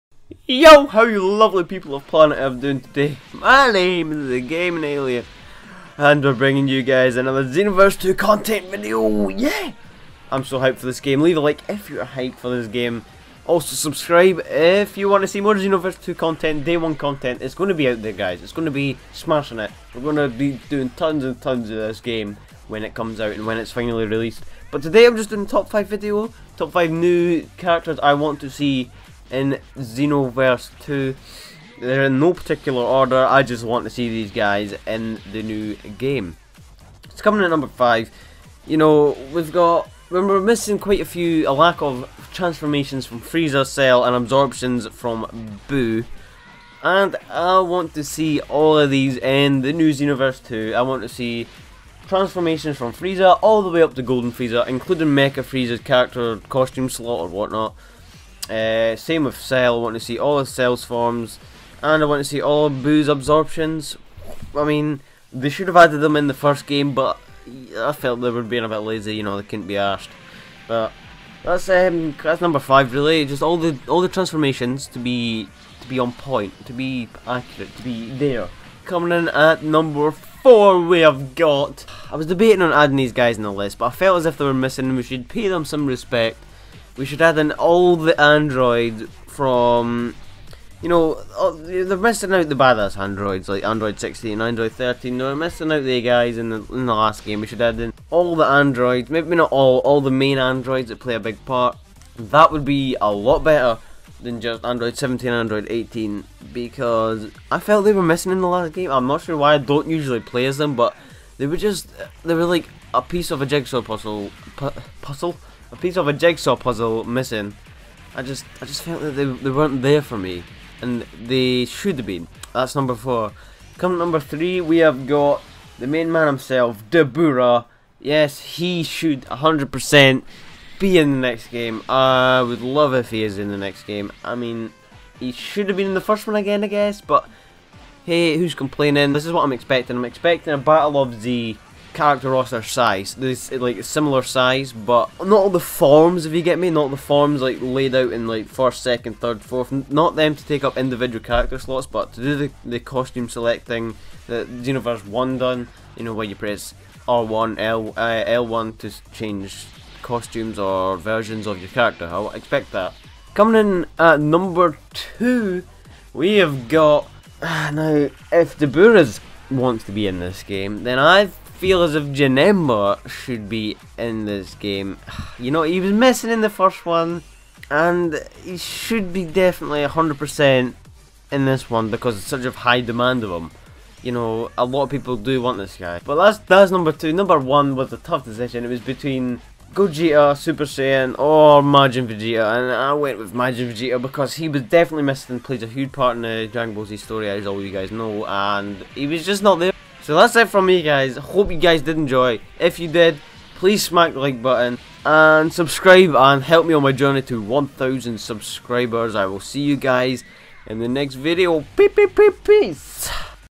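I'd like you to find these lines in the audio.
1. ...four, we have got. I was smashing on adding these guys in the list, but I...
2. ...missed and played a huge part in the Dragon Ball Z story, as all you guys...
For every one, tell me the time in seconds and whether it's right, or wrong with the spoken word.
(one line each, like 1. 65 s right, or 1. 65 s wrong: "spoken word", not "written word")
1. 80 s wrong: "debating", not "smashing"
2. 195 s right.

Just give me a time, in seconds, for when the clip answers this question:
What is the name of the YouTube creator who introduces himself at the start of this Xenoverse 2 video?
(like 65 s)
4 s.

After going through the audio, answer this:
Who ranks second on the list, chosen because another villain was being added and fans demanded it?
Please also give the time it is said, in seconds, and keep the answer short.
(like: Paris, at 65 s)
Janemba, at 172 s.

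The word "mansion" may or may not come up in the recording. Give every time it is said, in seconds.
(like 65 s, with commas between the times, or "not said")
not said.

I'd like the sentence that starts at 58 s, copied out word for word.
Uh, same with Cell, I want to see all of Cell's forms, and I want to see all of Buu's absorptions.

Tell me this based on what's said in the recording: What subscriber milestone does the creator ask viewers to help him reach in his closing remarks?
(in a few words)
1,000 subscribers.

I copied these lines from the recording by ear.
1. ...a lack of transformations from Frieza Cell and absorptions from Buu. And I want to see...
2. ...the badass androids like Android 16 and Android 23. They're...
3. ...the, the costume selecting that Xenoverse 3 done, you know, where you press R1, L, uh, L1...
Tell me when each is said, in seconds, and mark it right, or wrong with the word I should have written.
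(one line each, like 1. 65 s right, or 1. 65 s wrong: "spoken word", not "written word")
1. 41 s right
2. 92 s wrong: "13", not "23"
3. 152 s wrong: "1", not "3".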